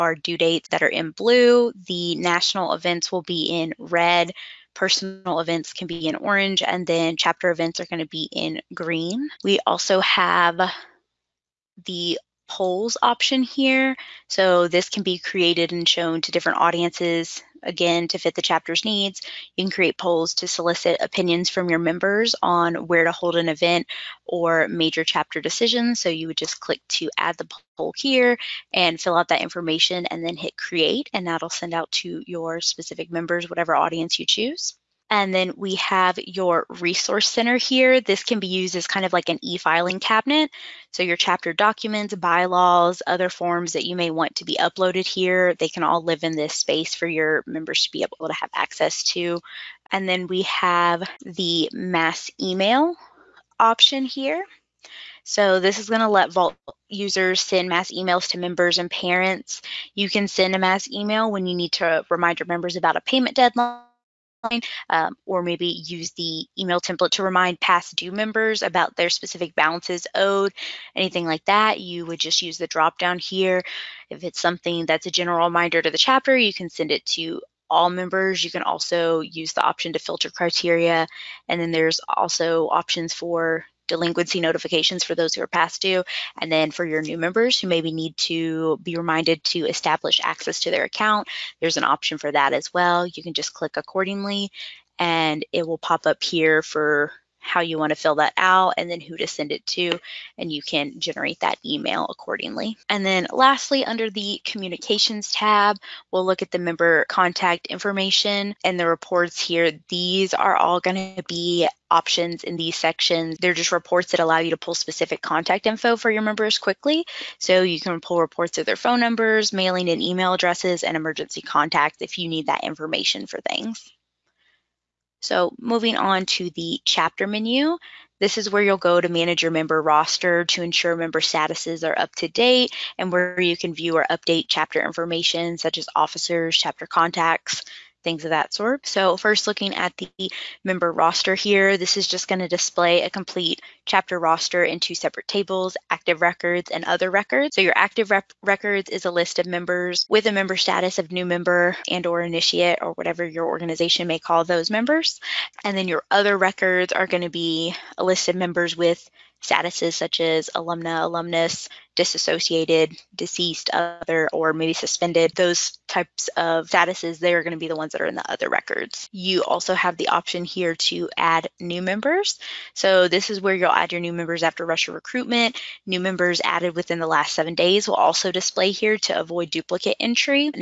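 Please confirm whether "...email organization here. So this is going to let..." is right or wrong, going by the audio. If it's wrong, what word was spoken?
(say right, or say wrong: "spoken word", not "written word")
wrong: "option", not "organization".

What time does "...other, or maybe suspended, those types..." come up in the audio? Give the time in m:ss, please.
2:43.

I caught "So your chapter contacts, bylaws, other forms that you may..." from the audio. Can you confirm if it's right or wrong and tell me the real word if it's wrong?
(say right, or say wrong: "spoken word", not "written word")
wrong: "documents", not "contacts".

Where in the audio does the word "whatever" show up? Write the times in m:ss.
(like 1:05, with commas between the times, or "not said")
0:33, 2:32.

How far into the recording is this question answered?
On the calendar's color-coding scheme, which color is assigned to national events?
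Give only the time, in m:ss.
0:03.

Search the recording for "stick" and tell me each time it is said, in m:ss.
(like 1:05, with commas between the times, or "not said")
not said.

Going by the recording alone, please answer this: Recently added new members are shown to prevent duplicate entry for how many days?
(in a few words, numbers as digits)
7.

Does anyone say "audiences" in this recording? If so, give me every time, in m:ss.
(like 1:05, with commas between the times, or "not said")
0:16, 0:33.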